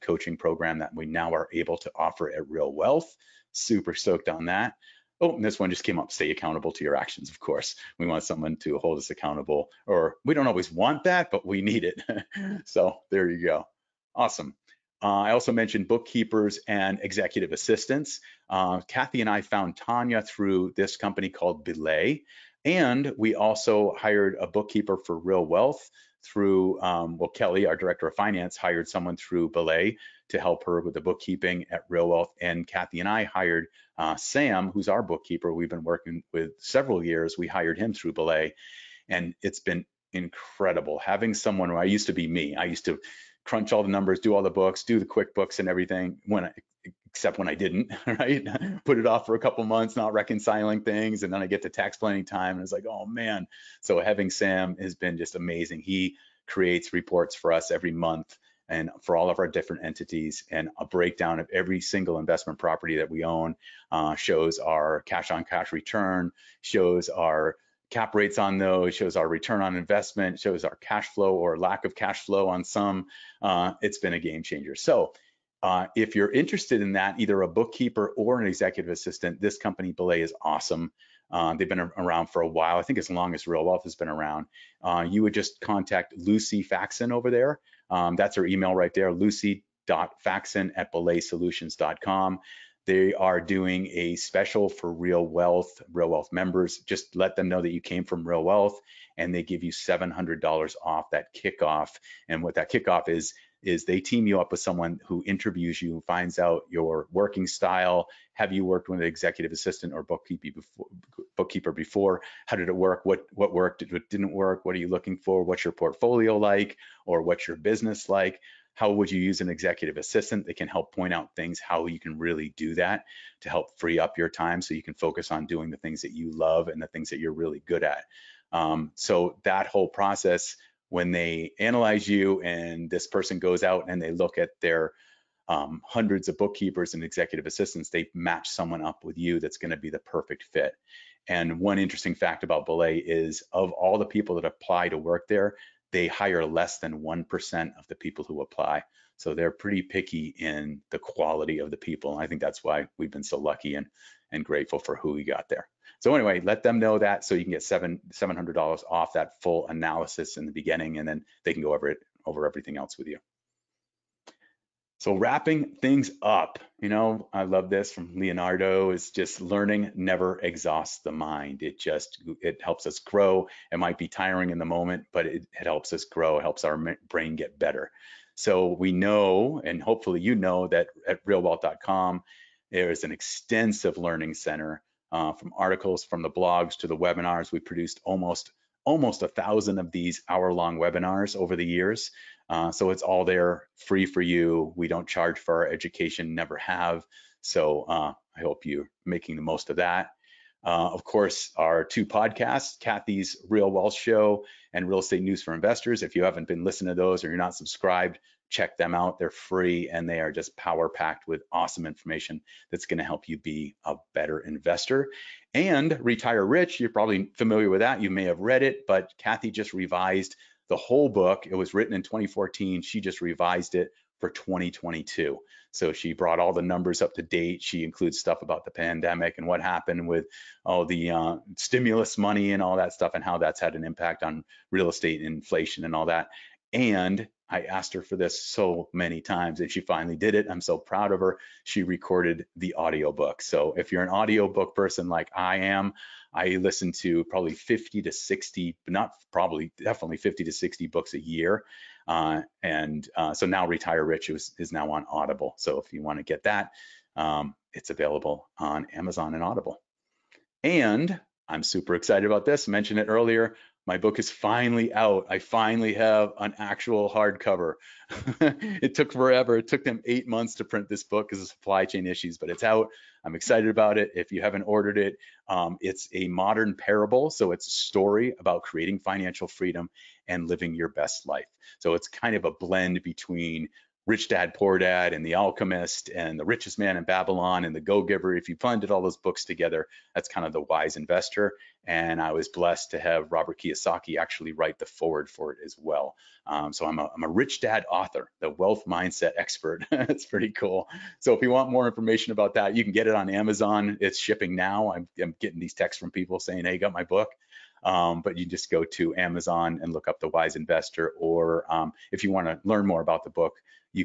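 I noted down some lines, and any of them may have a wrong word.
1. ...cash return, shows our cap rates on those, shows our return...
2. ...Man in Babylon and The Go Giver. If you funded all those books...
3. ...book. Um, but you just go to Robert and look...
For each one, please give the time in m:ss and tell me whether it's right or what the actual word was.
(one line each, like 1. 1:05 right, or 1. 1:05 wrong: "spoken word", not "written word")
1. 1:05 right
2. 4:46 right
3. 5:07 wrong: "Amazon", not "Robert".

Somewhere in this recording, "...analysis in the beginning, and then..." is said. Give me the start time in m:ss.
2:39.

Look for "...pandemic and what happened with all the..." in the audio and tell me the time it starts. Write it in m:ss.
3:48.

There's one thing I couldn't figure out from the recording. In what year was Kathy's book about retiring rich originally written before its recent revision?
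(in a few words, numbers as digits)
2014.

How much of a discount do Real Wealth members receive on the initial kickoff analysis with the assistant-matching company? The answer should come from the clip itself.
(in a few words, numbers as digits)
$700.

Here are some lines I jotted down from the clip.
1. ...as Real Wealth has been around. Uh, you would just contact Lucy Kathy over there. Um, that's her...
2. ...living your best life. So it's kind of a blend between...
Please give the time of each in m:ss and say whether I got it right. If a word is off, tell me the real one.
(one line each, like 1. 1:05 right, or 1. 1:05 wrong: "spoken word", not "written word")
1. 1:23 wrong: "Faxon", not "Kathy"
2. 4:40 right.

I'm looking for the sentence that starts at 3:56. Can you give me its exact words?
And I asked her for this so many times and she finally did it.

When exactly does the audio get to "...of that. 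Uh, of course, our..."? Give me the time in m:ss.
3:19.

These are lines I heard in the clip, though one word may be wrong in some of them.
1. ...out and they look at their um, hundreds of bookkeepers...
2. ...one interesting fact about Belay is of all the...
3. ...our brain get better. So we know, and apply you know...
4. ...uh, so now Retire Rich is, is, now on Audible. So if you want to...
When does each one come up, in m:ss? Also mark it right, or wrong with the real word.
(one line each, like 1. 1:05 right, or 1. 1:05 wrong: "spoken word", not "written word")
1. 2:13 right
2. 2:21 right
3. 2:56 wrong: "hopefully", not "apply"
4. 4:13 right.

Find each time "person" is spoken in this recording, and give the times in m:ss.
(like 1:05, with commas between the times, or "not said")
2:13, 4:04.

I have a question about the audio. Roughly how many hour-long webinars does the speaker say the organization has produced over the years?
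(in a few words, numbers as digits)
1,000.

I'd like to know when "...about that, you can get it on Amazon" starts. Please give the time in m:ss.
5:02.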